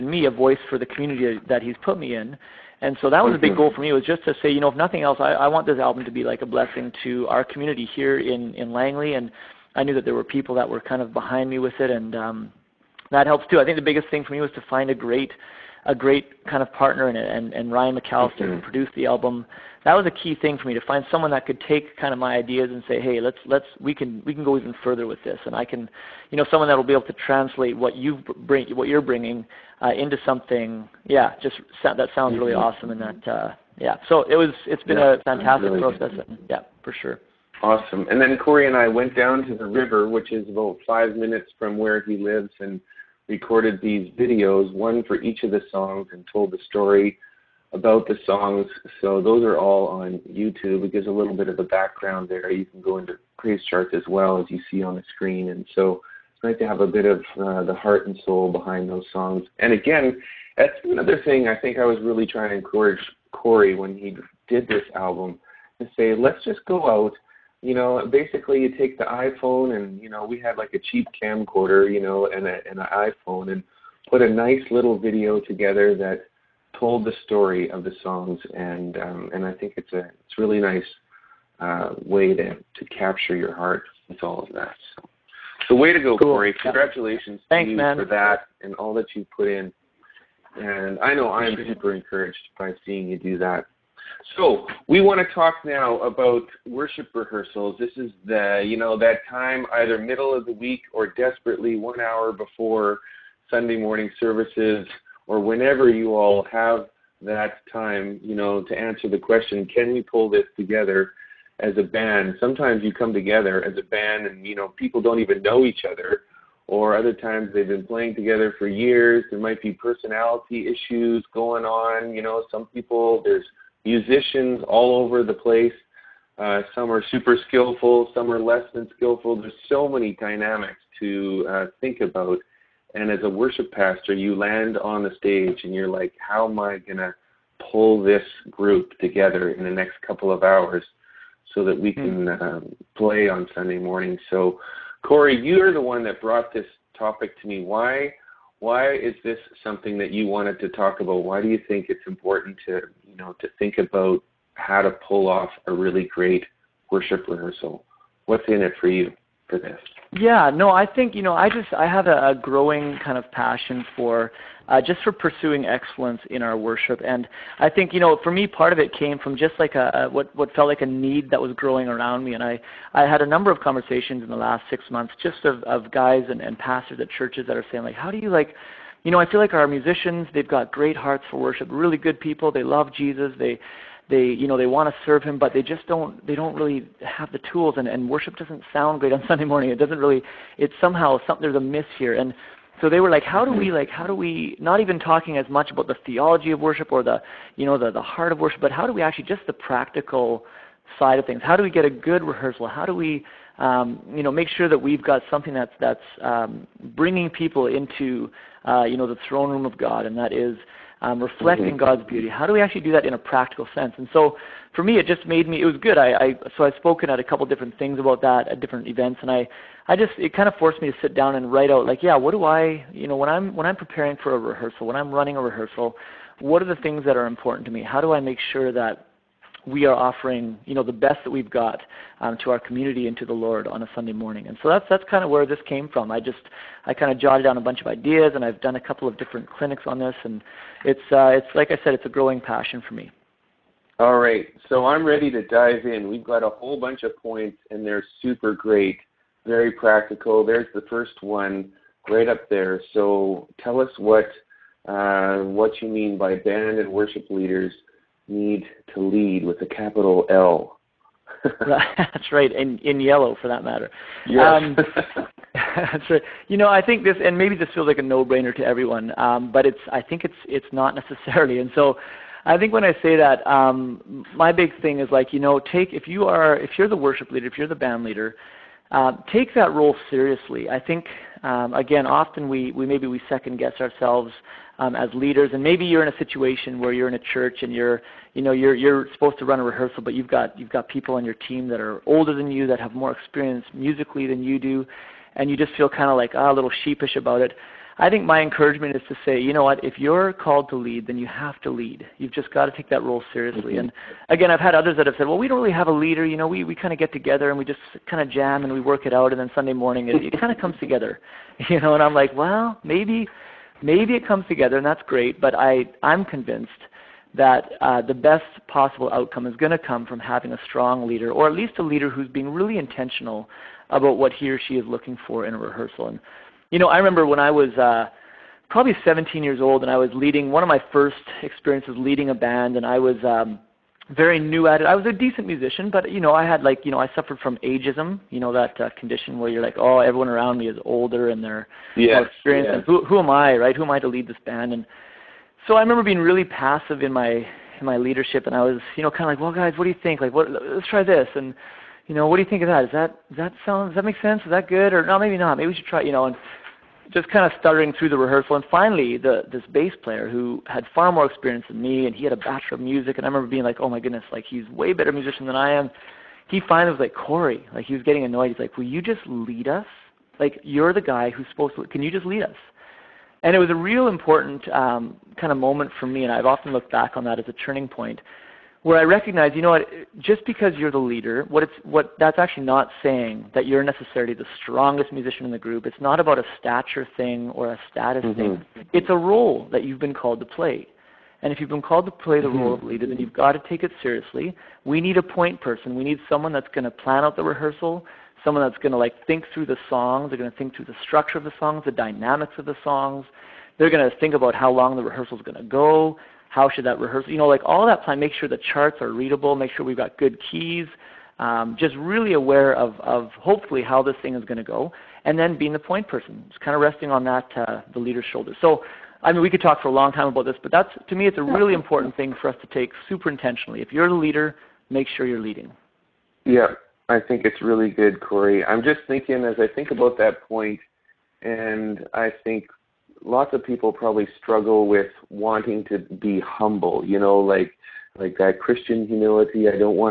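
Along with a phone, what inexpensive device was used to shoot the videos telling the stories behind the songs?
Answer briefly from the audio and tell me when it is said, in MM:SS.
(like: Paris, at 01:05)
Camcorder, at 01:11.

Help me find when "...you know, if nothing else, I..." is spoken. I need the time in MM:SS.
00:04.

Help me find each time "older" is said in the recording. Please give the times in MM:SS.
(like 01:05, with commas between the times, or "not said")
04:52, 05:40.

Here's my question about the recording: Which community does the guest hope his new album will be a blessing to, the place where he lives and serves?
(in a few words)
Langley.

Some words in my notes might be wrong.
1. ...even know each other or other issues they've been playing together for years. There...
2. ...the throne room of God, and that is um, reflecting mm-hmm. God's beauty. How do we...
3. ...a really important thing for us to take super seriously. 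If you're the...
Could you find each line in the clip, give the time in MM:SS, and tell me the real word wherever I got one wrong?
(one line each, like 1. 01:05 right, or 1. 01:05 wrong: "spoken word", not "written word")
1. 01:55 wrong: "times", not "issues"
2. 03:29 right
3. 07:01 wrong: "intentionally", not "seriously".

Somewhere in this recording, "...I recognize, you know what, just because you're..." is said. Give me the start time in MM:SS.
06:18.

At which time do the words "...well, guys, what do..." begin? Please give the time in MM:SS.
05:49.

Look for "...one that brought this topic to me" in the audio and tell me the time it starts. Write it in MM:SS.
02:25.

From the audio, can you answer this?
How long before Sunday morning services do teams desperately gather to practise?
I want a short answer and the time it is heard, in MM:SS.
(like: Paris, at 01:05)
1 hour, at 01:41.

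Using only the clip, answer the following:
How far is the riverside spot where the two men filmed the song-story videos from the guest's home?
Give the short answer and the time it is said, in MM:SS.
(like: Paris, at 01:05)
5 minutes, at 00:40.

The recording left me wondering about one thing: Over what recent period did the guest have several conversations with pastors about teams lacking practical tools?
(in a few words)
6 months.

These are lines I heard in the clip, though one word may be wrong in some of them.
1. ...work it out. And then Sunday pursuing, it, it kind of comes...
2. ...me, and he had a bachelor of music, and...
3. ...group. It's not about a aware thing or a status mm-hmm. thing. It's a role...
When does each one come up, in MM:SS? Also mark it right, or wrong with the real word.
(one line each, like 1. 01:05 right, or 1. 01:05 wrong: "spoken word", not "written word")
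1. 05:08 wrong: "morning", not "pursuing"
2. 06:01 right
3. 06:25 wrong: "stature", not "aware".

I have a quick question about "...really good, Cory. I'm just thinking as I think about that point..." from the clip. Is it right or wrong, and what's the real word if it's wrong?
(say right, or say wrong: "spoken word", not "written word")
right.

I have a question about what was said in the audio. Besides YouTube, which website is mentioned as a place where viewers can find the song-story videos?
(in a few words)
PraiseCharts.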